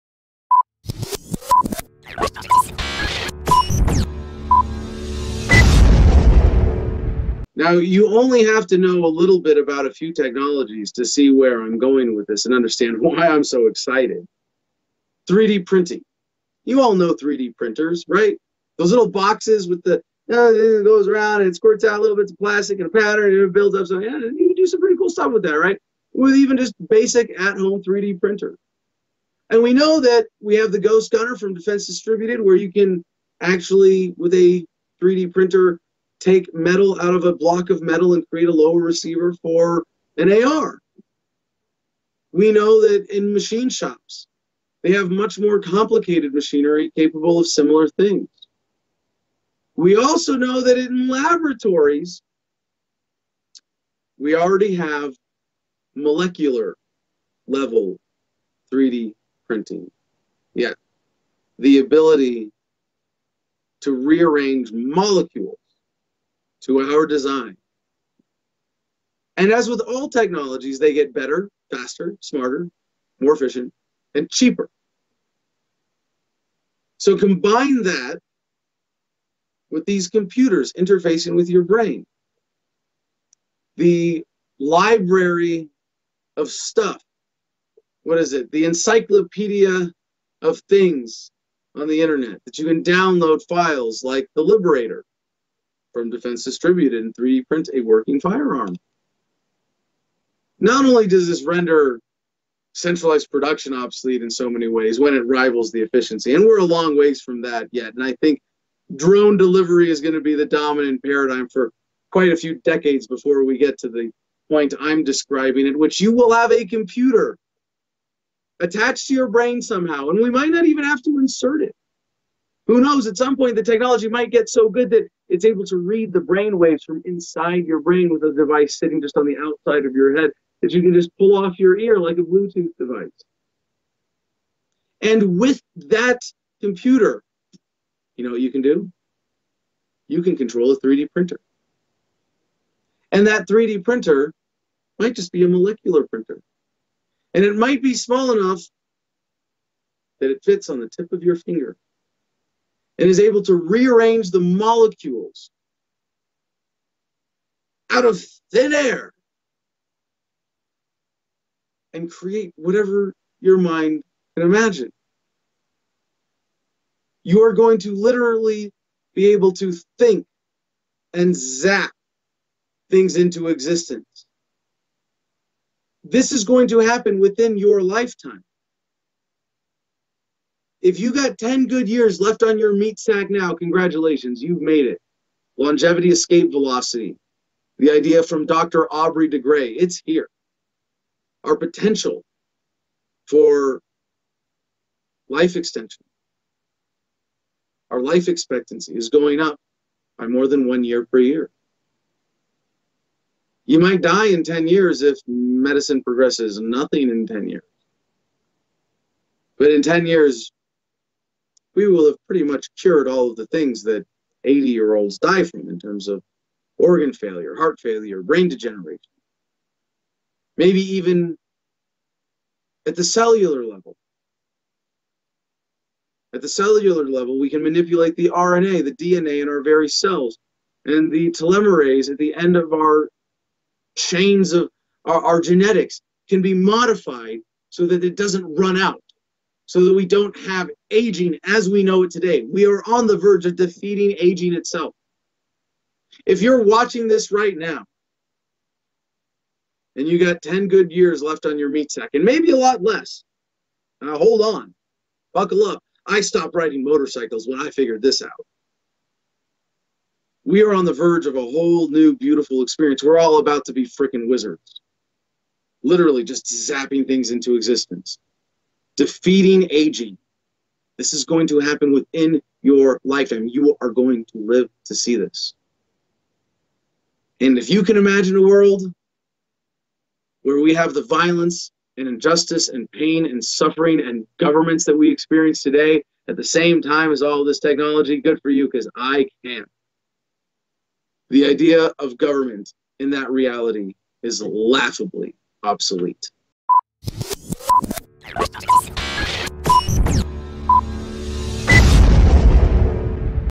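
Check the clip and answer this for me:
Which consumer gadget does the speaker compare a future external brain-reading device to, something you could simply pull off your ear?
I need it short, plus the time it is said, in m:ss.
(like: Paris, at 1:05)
Bluetooth device, at 2:12.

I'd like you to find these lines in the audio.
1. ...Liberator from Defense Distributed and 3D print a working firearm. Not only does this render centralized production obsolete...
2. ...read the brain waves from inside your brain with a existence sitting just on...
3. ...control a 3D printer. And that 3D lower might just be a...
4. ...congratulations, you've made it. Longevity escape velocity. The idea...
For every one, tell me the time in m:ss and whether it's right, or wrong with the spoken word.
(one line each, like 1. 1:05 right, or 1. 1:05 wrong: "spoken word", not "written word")
1. 1:34 right
2. 2:05 wrong: "device", not "existence"
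3. 2:20 wrong: "printer", not "lower"
4. 3:03 right.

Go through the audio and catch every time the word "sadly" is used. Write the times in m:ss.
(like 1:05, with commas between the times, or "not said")
not said.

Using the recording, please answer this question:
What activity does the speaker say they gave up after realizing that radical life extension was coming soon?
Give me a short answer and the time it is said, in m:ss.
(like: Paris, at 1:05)
riding motorcycles, at 4:16.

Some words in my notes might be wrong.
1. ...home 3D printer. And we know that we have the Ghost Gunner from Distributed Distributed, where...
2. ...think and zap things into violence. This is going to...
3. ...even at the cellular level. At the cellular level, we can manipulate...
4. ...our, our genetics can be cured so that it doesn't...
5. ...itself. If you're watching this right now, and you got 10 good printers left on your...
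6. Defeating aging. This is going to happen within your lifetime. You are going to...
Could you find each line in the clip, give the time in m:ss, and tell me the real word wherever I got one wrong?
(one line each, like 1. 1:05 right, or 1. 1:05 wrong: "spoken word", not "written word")
1. 0:27 wrong: "Defense", not "Distributed"
2. 2:49 wrong: "existence", not "violence"
3. 3:40 right
4. 3:55 wrong: "modified", not "cured"
5. 4:04 wrong: "years", not "printers"
6. 4:28 right.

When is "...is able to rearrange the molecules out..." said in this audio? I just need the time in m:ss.
2:33.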